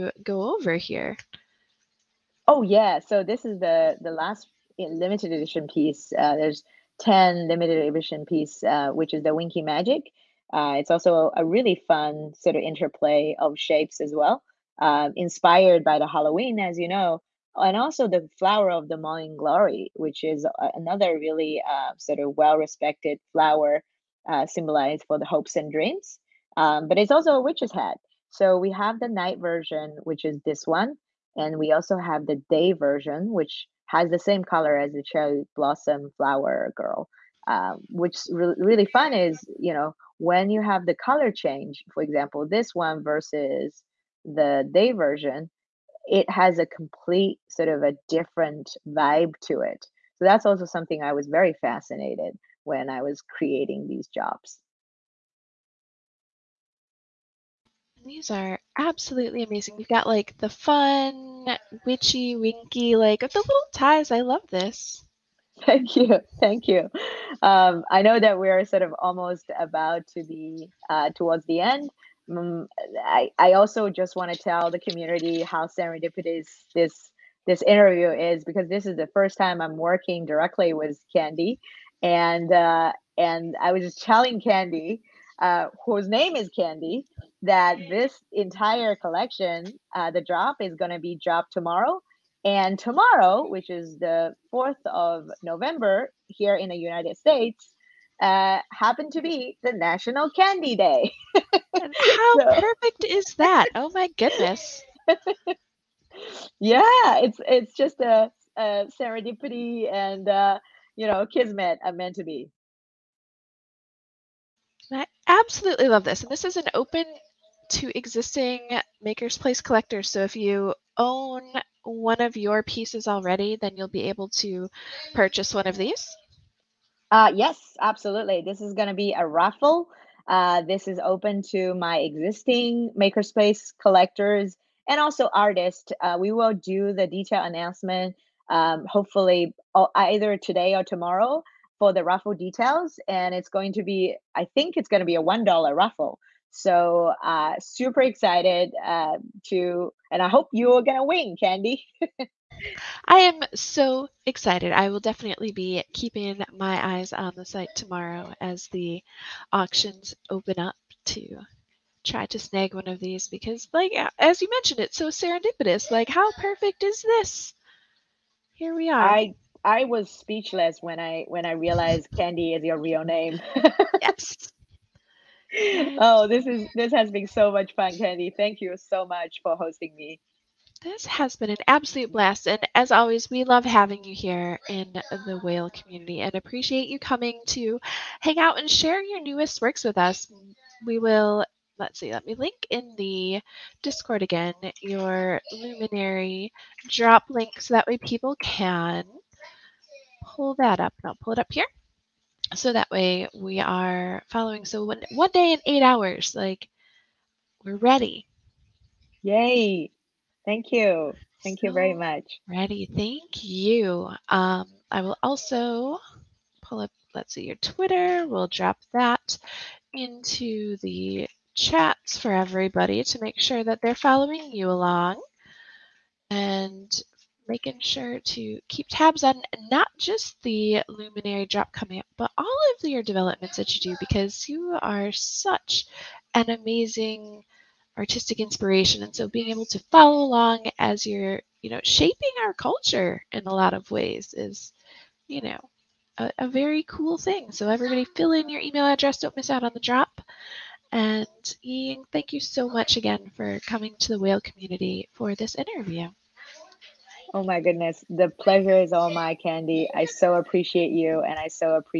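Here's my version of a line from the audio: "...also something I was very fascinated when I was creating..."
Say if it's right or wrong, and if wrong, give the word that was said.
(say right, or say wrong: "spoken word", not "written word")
right.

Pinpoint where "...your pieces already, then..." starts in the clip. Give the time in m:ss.
2:02.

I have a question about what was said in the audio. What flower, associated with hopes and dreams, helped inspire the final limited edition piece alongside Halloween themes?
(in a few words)
morning glory.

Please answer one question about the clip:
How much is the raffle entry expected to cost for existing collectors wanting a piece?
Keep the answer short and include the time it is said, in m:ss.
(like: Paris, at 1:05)
$1, at 2:25.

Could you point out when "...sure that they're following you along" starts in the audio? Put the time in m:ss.
3:43.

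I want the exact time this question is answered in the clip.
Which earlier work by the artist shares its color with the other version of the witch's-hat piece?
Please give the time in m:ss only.
0:35.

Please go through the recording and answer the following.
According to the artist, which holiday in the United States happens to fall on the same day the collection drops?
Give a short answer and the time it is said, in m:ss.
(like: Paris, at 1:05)
National Candy Day, at 1:39.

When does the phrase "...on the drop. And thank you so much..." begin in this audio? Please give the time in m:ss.
4:09.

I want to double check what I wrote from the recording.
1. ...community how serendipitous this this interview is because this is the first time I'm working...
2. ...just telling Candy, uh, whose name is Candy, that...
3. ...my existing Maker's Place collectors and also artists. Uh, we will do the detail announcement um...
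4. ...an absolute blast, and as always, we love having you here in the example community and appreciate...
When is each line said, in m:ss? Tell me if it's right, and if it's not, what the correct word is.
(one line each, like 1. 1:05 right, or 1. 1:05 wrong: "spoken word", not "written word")
1. 1:14 right
2. 1:23 right
3. 2:11 right
4. 3:01 wrong: "whale", not "example".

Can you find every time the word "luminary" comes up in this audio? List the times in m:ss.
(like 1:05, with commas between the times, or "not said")
3:15, 3:50.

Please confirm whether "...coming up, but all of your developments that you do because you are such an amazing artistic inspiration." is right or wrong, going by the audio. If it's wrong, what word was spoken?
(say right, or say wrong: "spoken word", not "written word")
right.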